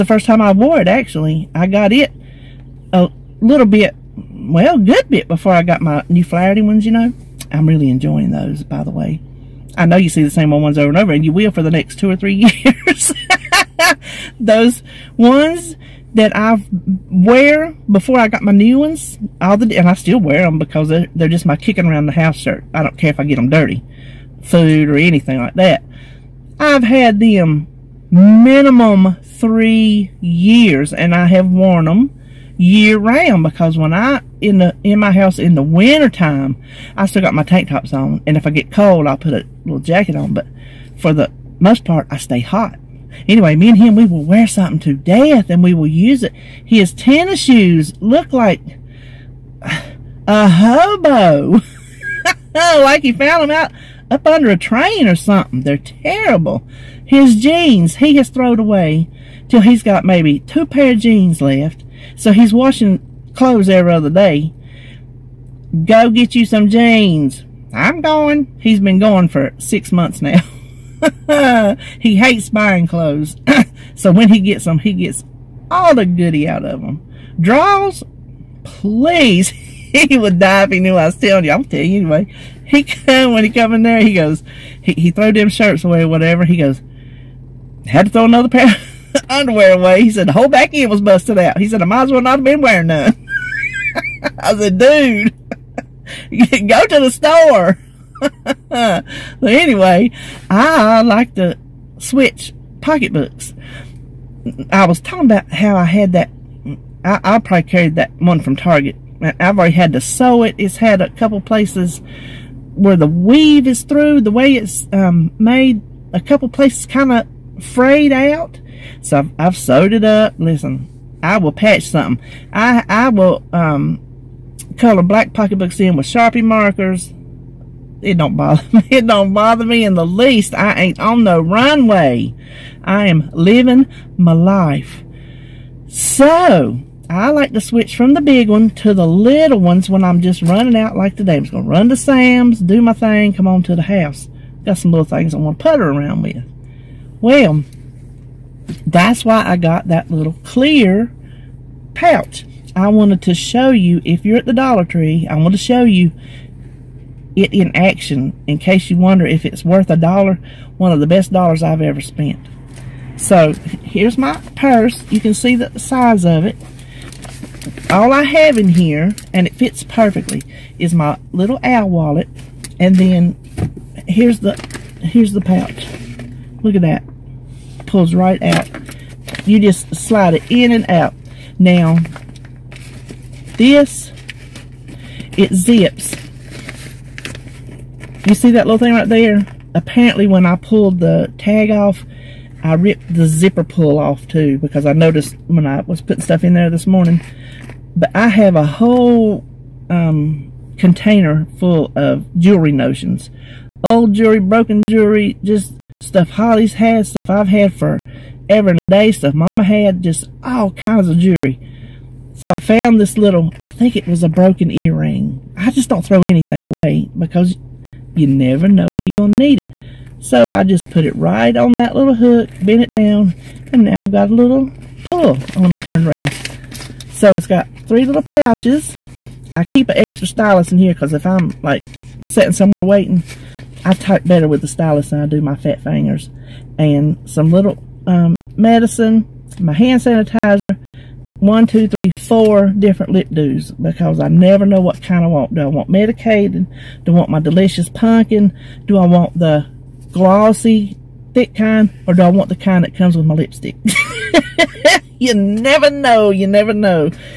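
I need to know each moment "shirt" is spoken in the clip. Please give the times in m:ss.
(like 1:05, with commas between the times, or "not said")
0:22, 1:25.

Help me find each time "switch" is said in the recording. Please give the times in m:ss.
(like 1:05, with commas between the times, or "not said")
1:41, 2:17.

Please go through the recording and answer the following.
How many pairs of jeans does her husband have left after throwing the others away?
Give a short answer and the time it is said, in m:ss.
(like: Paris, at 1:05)
2, at 1:00.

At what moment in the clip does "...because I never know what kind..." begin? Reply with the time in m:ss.
4:03.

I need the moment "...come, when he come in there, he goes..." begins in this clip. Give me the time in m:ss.
1:22.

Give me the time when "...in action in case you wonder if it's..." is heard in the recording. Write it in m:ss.
2:37.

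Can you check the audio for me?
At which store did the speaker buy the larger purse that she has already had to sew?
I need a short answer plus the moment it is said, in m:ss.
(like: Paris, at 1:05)
Target, at 1:48.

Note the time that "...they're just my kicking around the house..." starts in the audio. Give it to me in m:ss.
0:21.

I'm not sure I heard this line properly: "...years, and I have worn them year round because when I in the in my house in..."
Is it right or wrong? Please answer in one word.
right.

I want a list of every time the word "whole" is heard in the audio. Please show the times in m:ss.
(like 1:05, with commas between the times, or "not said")
1:30, 3:18.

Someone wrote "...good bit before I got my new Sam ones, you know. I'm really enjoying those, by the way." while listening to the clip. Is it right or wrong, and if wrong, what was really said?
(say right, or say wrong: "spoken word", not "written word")
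wrong: "Flaherty", not "Sam".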